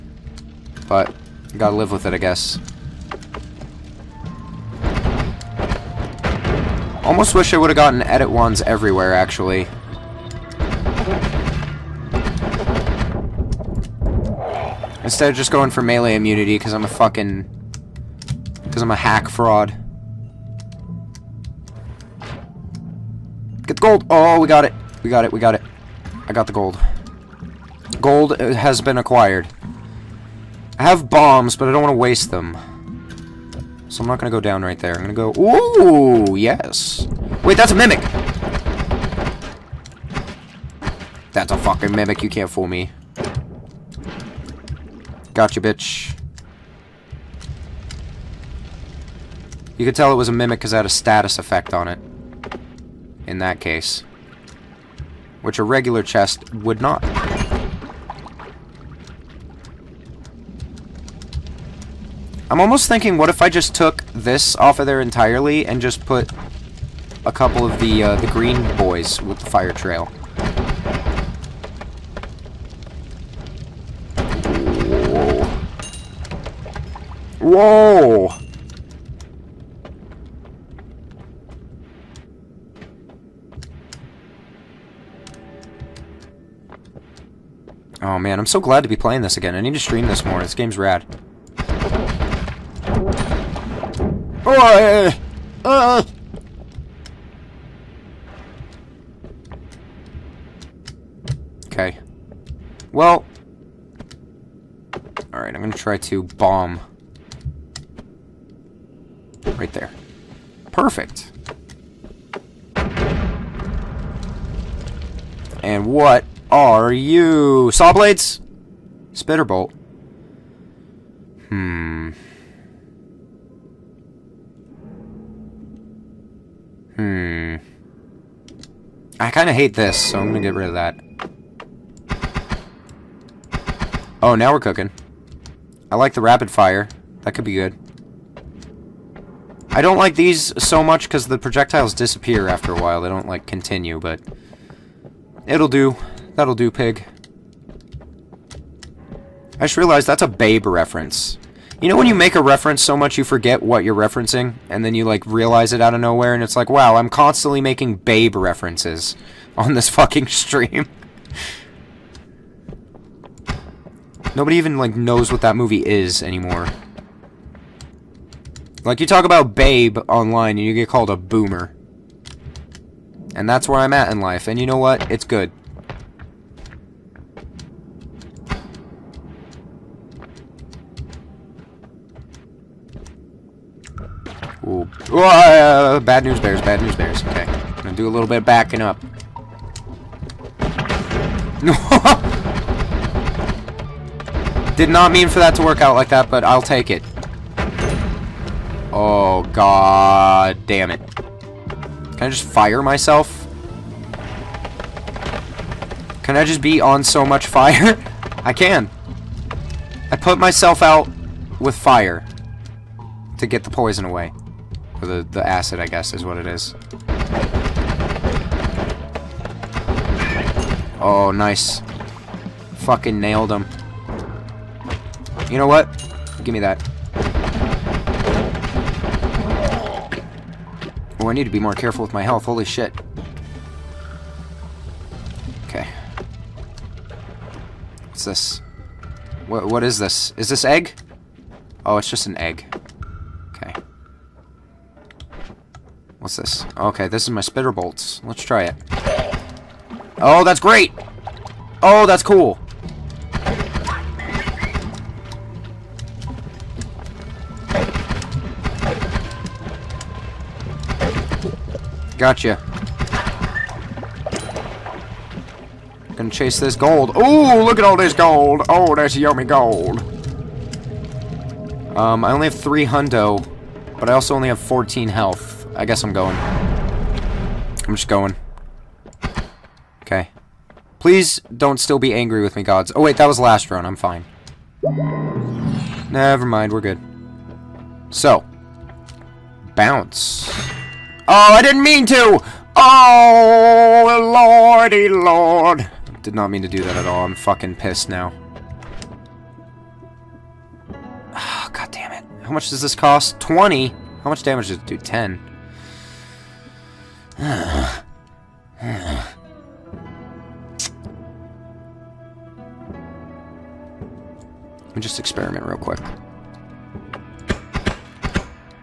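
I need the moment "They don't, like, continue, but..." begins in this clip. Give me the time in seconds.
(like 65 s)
142 s.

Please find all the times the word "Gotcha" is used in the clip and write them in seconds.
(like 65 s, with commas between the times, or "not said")
45 s, 262 s.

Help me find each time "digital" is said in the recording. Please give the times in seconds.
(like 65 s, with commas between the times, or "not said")
not said.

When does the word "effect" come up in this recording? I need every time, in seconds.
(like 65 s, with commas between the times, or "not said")
51 s.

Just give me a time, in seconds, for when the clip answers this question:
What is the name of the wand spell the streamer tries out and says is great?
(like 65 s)
247 s.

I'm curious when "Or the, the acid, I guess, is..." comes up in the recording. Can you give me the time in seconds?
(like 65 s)
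215 s.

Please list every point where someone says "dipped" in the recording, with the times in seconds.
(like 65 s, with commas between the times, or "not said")
not said.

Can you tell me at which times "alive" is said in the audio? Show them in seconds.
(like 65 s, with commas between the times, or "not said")
not said.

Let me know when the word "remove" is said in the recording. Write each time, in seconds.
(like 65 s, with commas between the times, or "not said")
not said.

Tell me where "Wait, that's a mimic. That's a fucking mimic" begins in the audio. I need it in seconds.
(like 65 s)
37 s.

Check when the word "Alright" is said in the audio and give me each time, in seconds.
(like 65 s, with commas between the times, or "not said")
105 s.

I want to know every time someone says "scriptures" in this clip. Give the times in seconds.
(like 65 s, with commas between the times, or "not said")
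not said.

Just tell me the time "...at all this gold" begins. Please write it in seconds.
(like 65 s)
267 s.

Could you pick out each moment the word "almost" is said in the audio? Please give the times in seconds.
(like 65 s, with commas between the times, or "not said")
7 s, 62 s.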